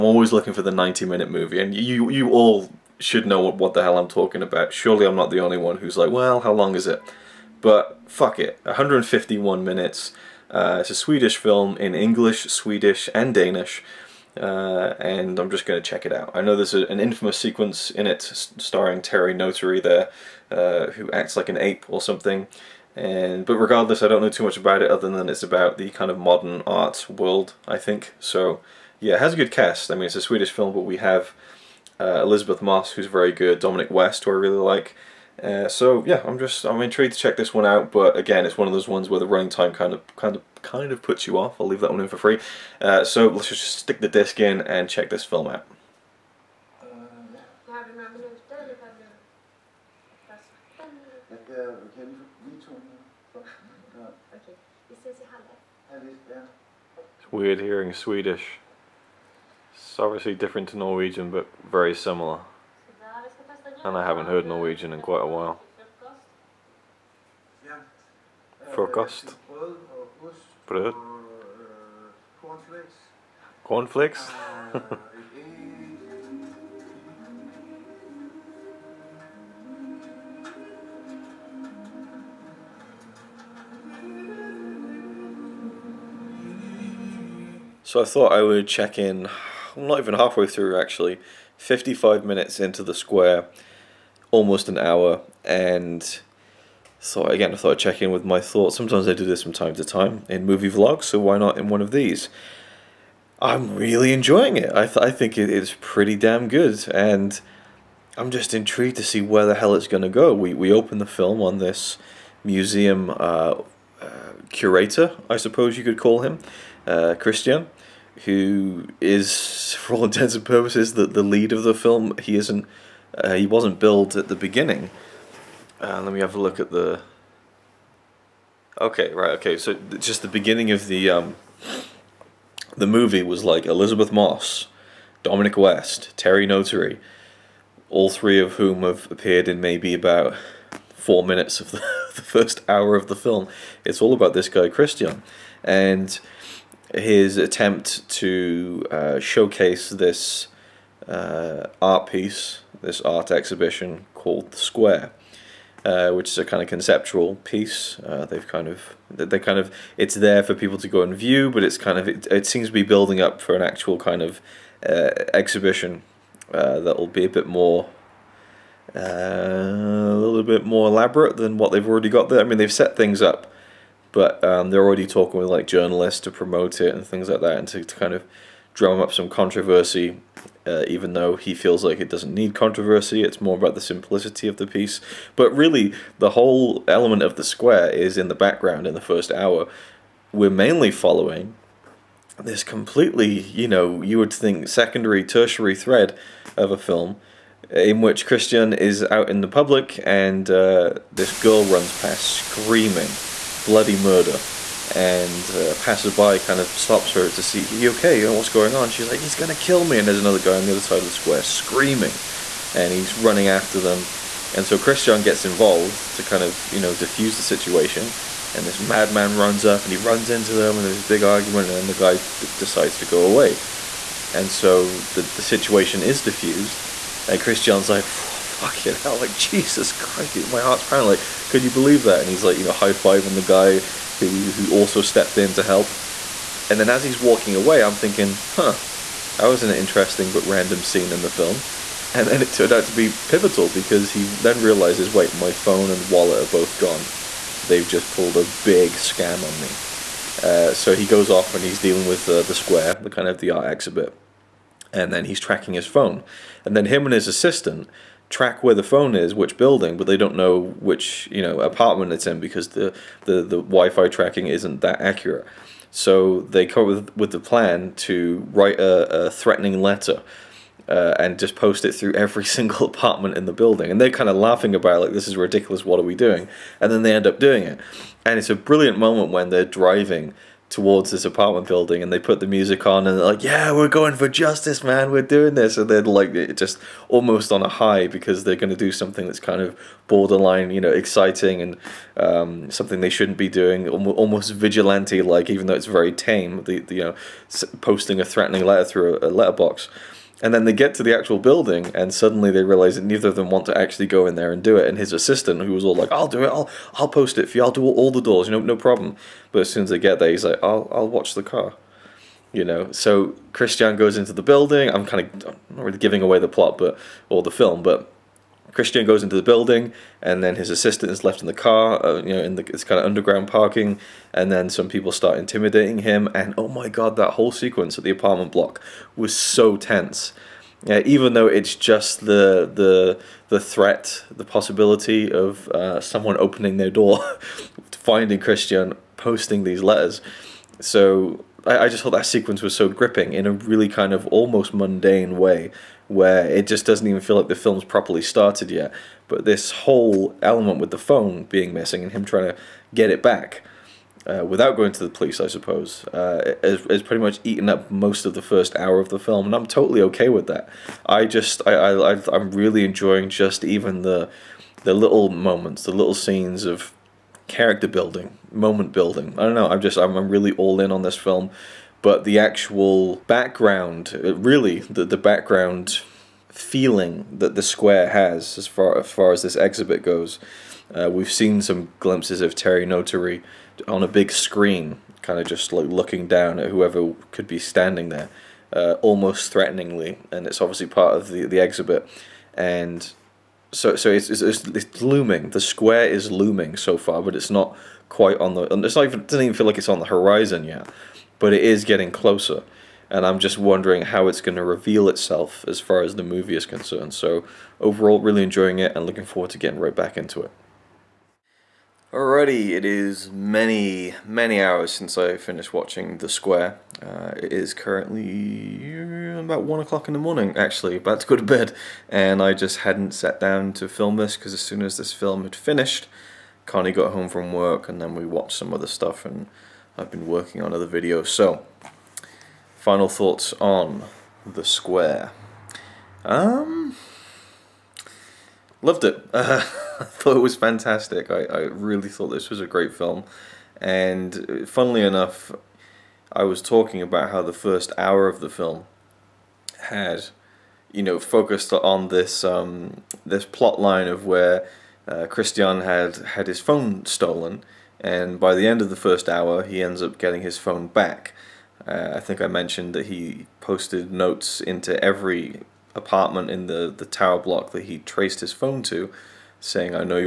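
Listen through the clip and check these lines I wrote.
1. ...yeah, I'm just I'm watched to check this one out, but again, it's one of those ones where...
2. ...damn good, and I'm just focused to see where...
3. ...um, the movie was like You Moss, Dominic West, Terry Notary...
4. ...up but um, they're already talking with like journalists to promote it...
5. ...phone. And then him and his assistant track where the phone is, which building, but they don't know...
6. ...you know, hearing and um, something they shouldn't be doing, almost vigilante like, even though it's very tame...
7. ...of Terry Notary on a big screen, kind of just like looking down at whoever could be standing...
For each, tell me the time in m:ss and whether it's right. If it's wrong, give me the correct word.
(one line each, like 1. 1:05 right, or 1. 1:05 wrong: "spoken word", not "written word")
1. 0:36 wrong: "intrigued", not "watched"
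2. 1:46 wrong: "intrigued", not "focused"
3. 2:11 wrong: "Elisabeth", not "You"
4. 2:53 right
5. 4:15 right
6. 4:50 wrong: "exciting", not "hearing"
7. 6:22 right.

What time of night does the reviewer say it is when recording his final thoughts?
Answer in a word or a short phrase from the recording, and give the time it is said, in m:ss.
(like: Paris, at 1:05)
1 o'clock, at 6:59.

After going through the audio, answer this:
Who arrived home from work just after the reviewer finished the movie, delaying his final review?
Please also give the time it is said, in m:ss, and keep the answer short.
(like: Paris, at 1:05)
Connie, at 7:06.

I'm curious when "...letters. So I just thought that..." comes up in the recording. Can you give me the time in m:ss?
5:39.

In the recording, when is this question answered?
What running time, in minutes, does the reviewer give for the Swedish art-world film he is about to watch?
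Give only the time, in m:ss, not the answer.
0:08.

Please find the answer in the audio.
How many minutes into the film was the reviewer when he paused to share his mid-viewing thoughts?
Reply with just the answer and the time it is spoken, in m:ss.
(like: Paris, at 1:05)
55, at 1:31.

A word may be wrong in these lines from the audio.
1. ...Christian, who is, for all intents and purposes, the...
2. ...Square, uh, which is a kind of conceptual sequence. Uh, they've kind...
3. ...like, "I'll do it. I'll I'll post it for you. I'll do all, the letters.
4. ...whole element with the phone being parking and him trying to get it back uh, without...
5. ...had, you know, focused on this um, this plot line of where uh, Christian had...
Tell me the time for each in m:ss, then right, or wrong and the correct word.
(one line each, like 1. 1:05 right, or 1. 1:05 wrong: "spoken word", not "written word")
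1. 1:57 right
2. 2:34 wrong: "piece", not "sequence"
3. 5:05 wrong: "doors", not "letters"
4. 5:49 wrong: "missing", not "parking"
5. 7:29 right.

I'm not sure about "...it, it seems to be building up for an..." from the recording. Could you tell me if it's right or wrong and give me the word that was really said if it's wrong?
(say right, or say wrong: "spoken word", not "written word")
right.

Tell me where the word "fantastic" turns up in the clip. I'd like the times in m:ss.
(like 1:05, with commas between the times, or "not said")
7:20.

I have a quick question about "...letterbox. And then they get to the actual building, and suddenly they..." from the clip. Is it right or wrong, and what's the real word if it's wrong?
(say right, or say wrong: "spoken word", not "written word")
right.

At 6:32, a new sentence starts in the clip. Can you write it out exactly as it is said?
And so, so it's, it's, it's, looming.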